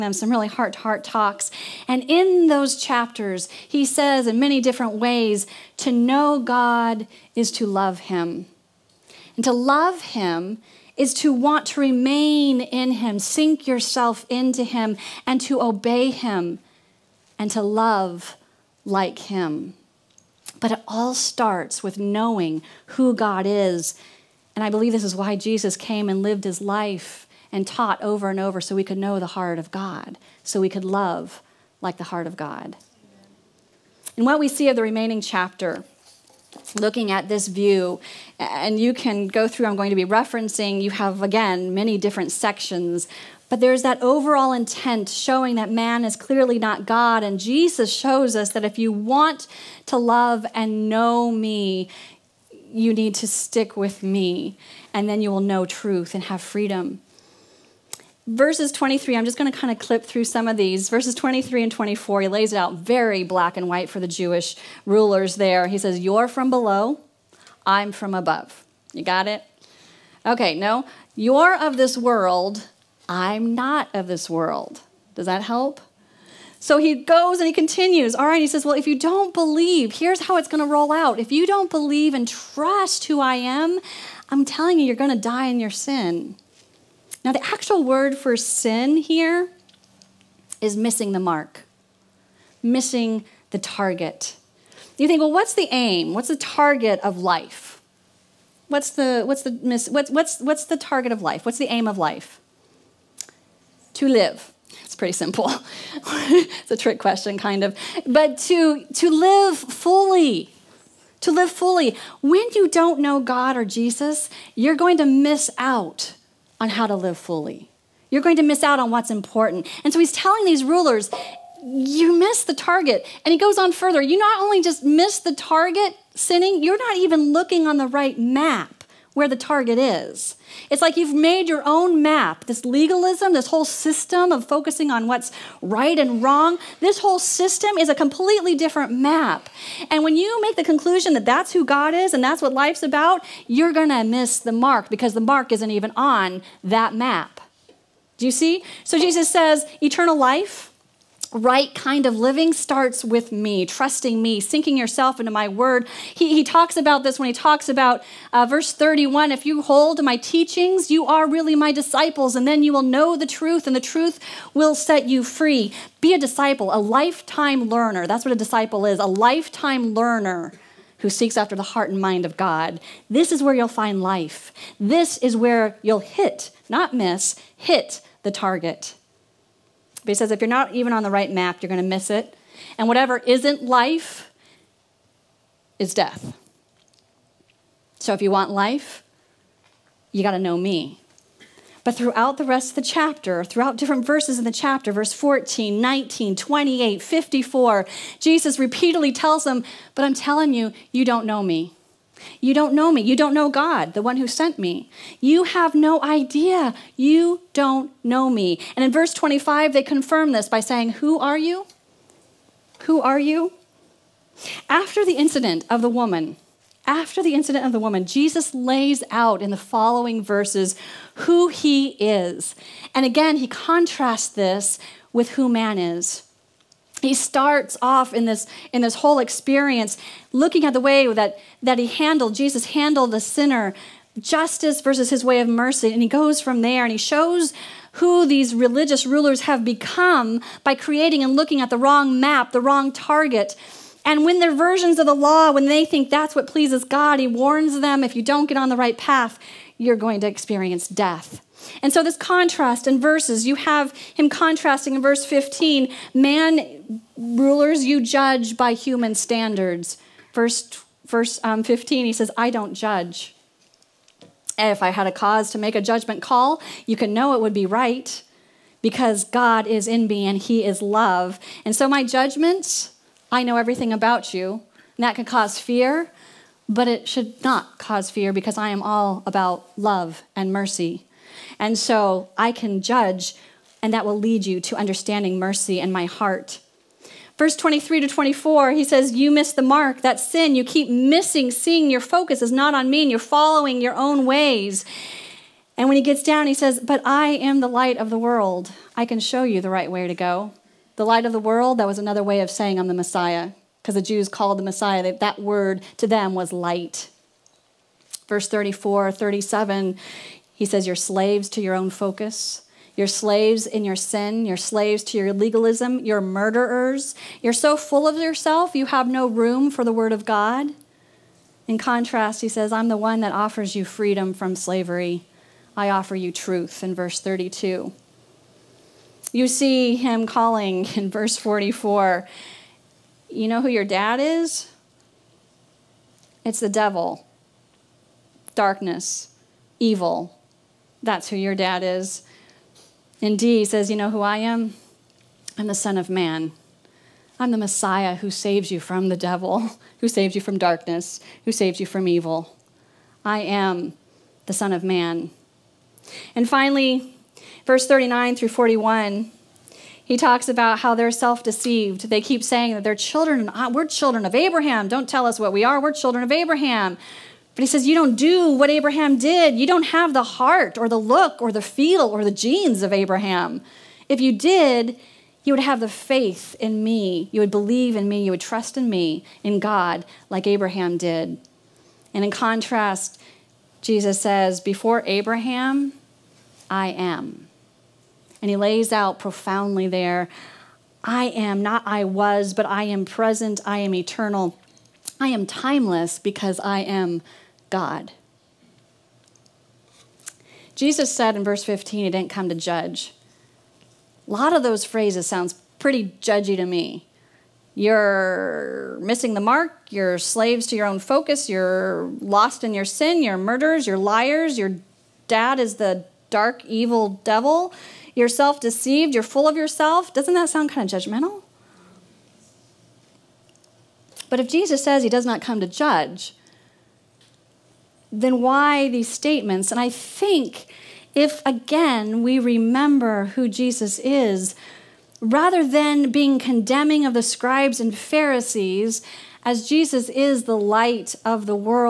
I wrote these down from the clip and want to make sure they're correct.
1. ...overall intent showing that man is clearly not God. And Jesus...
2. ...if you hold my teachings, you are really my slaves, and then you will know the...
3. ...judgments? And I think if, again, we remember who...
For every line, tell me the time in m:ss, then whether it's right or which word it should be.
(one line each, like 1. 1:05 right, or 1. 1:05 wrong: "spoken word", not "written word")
1. 0:44 right
2. 2:39 wrong: "disciples", not "slaves"
3. 7:09 wrong: "statements", not "judgments".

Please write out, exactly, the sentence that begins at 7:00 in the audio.
Doesn't that sound kind of judgmental?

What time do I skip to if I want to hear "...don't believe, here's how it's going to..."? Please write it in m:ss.
1:18.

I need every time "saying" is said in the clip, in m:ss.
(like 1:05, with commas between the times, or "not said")
3:30, 5:02, 6:02.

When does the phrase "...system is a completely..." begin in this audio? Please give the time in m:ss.
2:17.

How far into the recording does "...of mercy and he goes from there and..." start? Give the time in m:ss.
3:55.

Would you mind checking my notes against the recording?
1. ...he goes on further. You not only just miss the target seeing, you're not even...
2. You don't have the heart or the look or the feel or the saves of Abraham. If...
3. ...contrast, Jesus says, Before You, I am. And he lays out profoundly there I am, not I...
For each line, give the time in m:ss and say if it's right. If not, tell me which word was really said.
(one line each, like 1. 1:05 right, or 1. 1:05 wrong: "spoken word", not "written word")
1. 2:03 wrong: "sinning", not "seeing"
2. 6:09 wrong: "genes", not "saves"
3. 6:22 wrong: "Abraham", not "You".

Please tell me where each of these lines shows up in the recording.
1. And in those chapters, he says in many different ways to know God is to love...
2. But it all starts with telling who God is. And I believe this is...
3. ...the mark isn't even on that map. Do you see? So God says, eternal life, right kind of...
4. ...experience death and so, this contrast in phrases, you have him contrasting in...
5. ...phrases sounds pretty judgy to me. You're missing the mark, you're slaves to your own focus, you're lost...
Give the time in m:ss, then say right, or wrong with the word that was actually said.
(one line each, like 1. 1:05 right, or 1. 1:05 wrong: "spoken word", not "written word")
1. 0:01 right
2. 0:20 wrong: "knowing", not "telling"
3. 2:25 wrong: "Jesus", not "God"
4. 4:10 wrong: "verses", not "phrases"
5. 6:44 right.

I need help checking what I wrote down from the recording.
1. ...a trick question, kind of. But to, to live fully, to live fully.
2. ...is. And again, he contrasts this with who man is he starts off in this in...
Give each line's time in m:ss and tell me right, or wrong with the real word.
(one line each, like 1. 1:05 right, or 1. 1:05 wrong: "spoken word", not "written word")
1. 1:46 right
2. 3:41 right.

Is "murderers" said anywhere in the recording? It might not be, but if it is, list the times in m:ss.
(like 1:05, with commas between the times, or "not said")
5:16, 6:53.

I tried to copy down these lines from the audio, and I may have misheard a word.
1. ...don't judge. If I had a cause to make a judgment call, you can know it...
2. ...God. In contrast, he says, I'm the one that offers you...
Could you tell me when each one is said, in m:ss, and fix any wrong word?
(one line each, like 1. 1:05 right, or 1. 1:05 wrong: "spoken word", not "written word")
1. 4:22 right
2. 5:20 right.